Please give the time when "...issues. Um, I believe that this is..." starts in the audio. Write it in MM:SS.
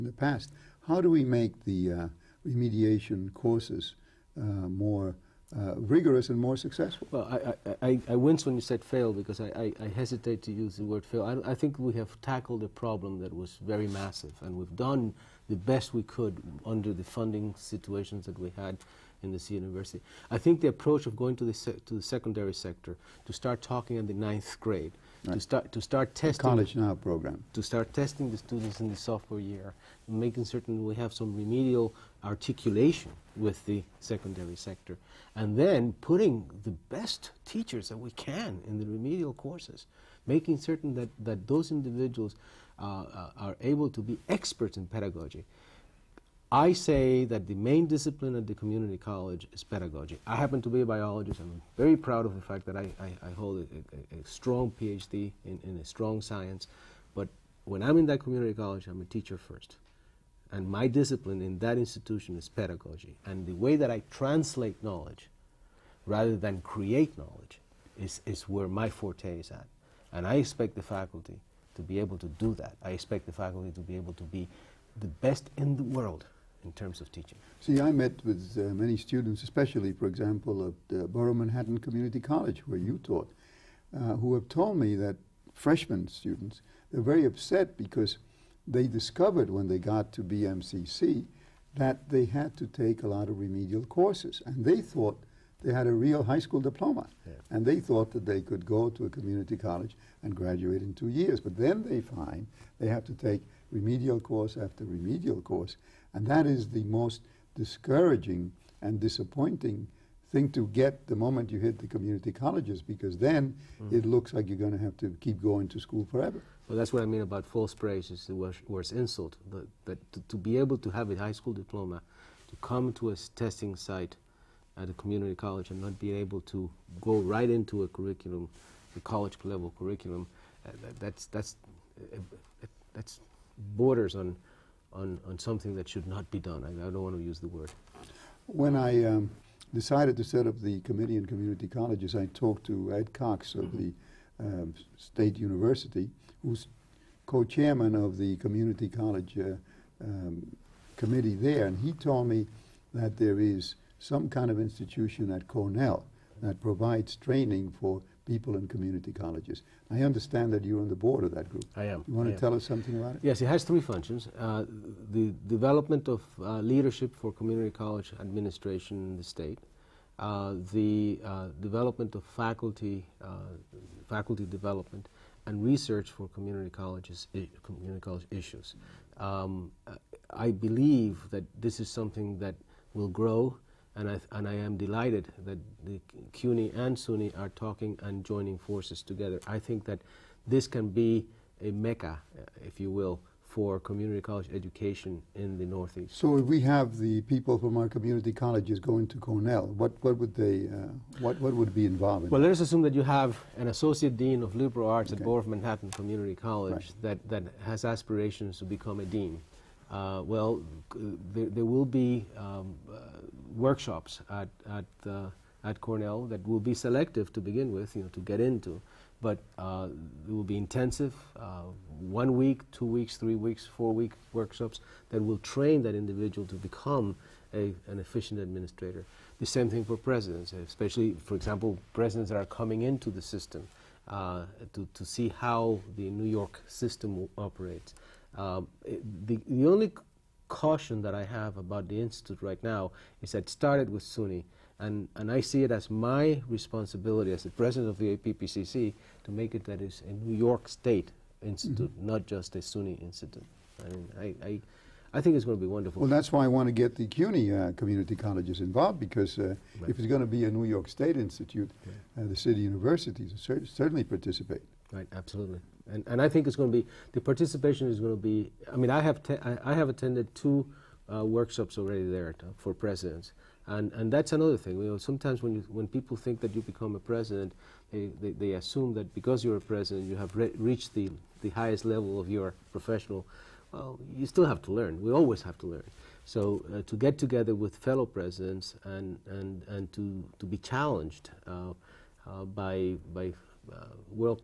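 02:58.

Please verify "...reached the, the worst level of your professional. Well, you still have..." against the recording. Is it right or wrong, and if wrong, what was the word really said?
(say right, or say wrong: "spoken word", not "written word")
wrong: "highest", not "worst".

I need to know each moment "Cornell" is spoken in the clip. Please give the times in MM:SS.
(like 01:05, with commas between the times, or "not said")
02:35, 03:19, 03:35.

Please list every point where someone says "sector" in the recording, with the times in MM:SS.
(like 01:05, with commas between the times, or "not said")
00:22, 00:34.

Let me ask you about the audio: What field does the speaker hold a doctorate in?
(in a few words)
Biologist.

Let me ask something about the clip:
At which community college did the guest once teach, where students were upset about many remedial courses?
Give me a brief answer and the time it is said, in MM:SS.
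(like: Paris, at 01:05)
Borough of Manhattan Community College, at 01:21.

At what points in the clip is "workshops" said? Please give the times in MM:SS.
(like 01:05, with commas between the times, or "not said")
03:33, 03:44, 04:31.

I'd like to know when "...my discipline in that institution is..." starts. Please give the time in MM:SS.
01:00.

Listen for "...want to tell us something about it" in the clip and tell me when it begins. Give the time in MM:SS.
02:42.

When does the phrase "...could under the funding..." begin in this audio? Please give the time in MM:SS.
00:16.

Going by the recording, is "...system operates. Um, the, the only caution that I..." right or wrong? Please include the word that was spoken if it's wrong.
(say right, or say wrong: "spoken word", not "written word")
right.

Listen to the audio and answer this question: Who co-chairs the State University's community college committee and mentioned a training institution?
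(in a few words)
Ed Cox.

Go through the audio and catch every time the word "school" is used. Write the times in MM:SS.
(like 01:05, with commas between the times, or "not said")
01:36, 01:55, 02:01.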